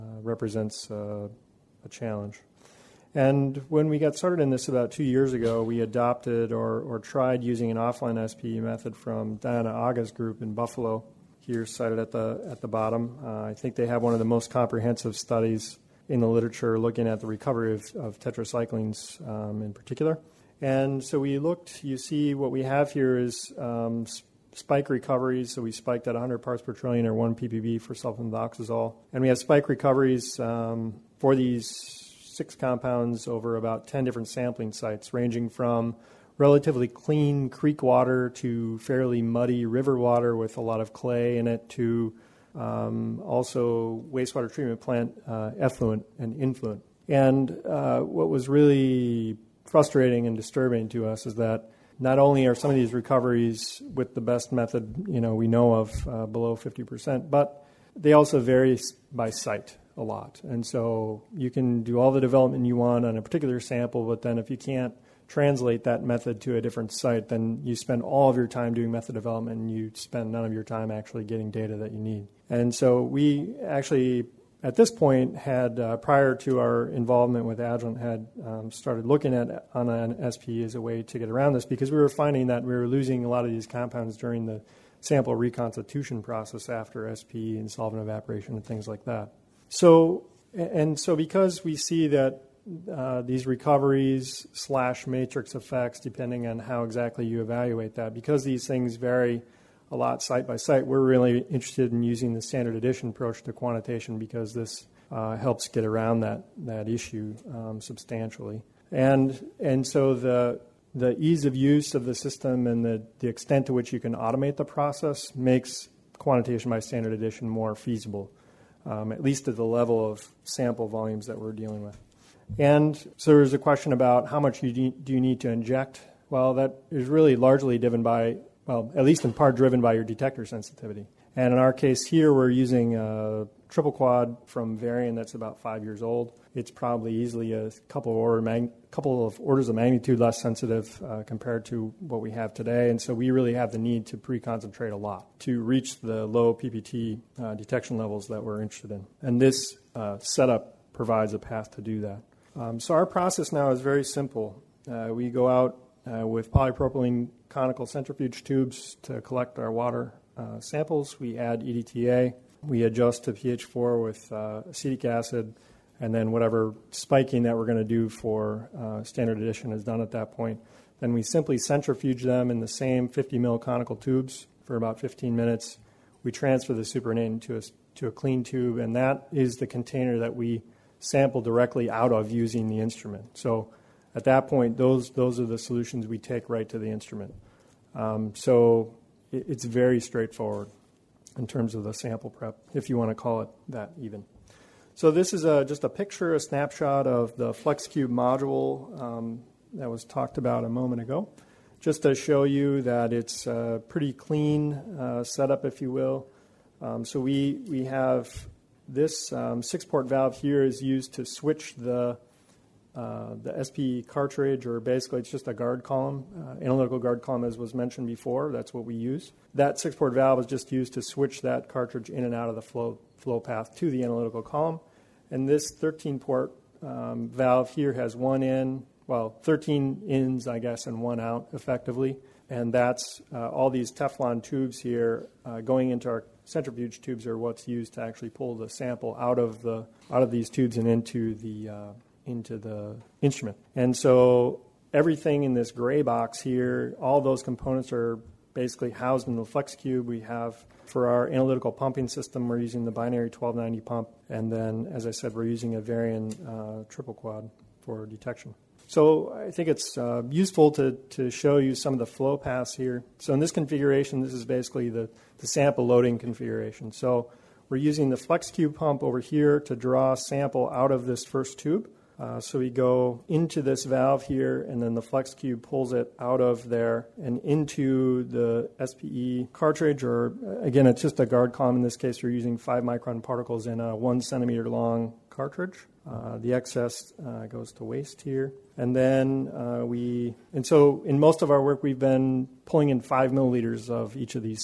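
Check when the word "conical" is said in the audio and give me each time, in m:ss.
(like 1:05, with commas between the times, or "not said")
2:37, 2:53.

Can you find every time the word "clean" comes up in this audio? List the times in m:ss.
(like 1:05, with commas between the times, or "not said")
0:36, 2:58, 3:24.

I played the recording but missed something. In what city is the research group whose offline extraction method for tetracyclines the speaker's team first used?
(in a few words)
Buffalo.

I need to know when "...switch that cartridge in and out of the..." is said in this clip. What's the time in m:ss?
3:41.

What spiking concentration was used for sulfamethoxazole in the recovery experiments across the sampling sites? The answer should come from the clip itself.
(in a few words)
1 ppb.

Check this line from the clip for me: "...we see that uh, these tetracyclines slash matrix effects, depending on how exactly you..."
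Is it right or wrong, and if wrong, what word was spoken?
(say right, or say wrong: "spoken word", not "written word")
wrong: "recoveries", not "tetracyclines".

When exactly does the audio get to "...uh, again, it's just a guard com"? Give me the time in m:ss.
4:40.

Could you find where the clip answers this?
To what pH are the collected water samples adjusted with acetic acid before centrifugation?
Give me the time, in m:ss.
2:43.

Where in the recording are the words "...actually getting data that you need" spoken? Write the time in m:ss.
1:10.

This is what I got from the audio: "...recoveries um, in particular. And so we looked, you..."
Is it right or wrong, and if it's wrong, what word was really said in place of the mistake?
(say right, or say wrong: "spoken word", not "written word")
wrong: "tetracyclines", not "recoveries".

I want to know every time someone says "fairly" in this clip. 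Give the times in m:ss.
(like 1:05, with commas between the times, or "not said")
0:38.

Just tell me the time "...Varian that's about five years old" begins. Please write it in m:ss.
2:14.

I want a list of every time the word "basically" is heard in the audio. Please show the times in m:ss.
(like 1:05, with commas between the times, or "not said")
3:34, 4:08, 4:24.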